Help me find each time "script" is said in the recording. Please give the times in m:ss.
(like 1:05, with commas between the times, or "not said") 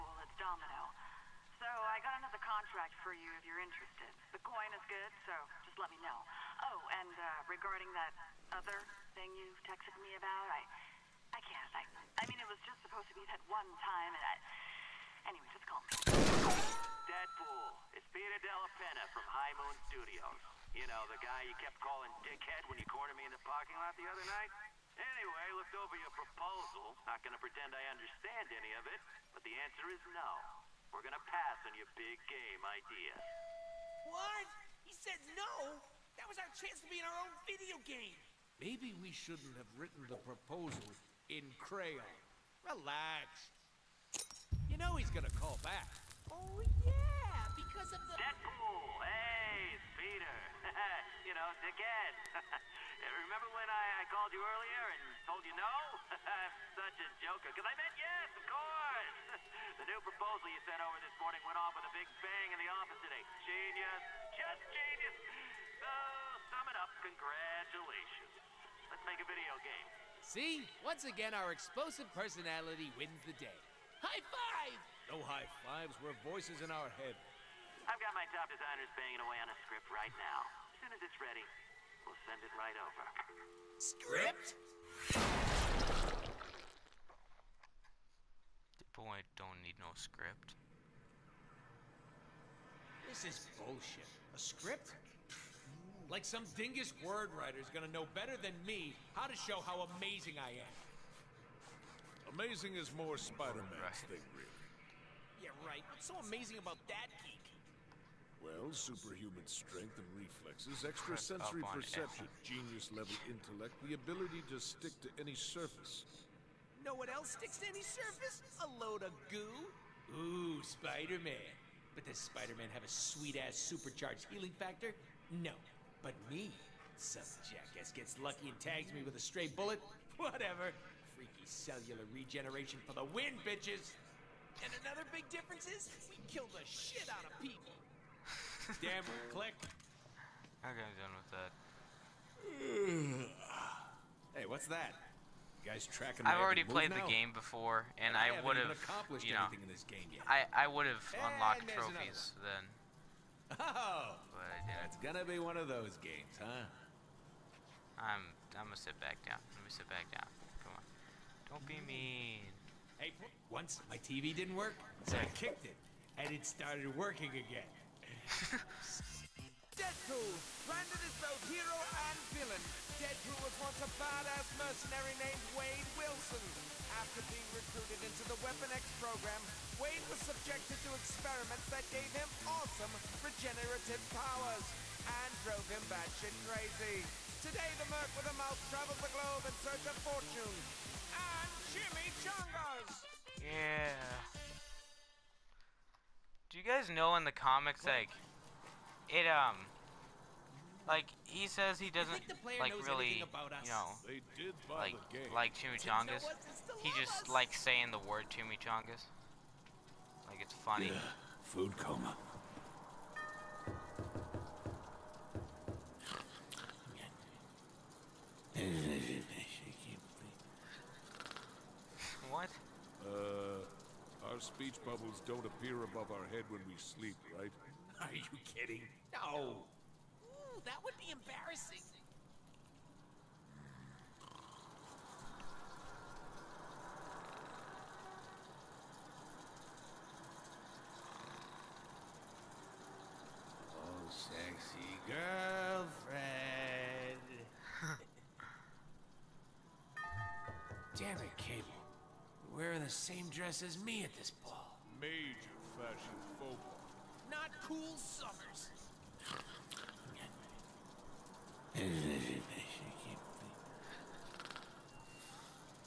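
1:19, 1:23, 1:29, 1:34.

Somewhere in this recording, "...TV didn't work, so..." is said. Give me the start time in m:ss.
2:43.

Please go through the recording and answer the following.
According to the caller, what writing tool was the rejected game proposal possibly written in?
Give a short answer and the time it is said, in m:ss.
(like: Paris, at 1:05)
Crayon, at 0:41.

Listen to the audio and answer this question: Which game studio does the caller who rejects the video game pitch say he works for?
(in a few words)
High Moon Studios.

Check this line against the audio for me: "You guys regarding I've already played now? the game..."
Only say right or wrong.
wrong.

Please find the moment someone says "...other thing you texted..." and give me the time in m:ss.
0:08.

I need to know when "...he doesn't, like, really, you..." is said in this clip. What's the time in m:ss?
3:21.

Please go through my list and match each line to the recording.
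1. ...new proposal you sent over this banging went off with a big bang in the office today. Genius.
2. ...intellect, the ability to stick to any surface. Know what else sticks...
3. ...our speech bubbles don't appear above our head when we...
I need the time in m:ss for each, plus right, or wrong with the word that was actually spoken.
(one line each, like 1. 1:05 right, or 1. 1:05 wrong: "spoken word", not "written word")
1. 0:59 wrong: "morning", not "banging"
2. 1:53 right
3. 3:44 right.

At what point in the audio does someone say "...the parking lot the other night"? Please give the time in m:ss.
0:23.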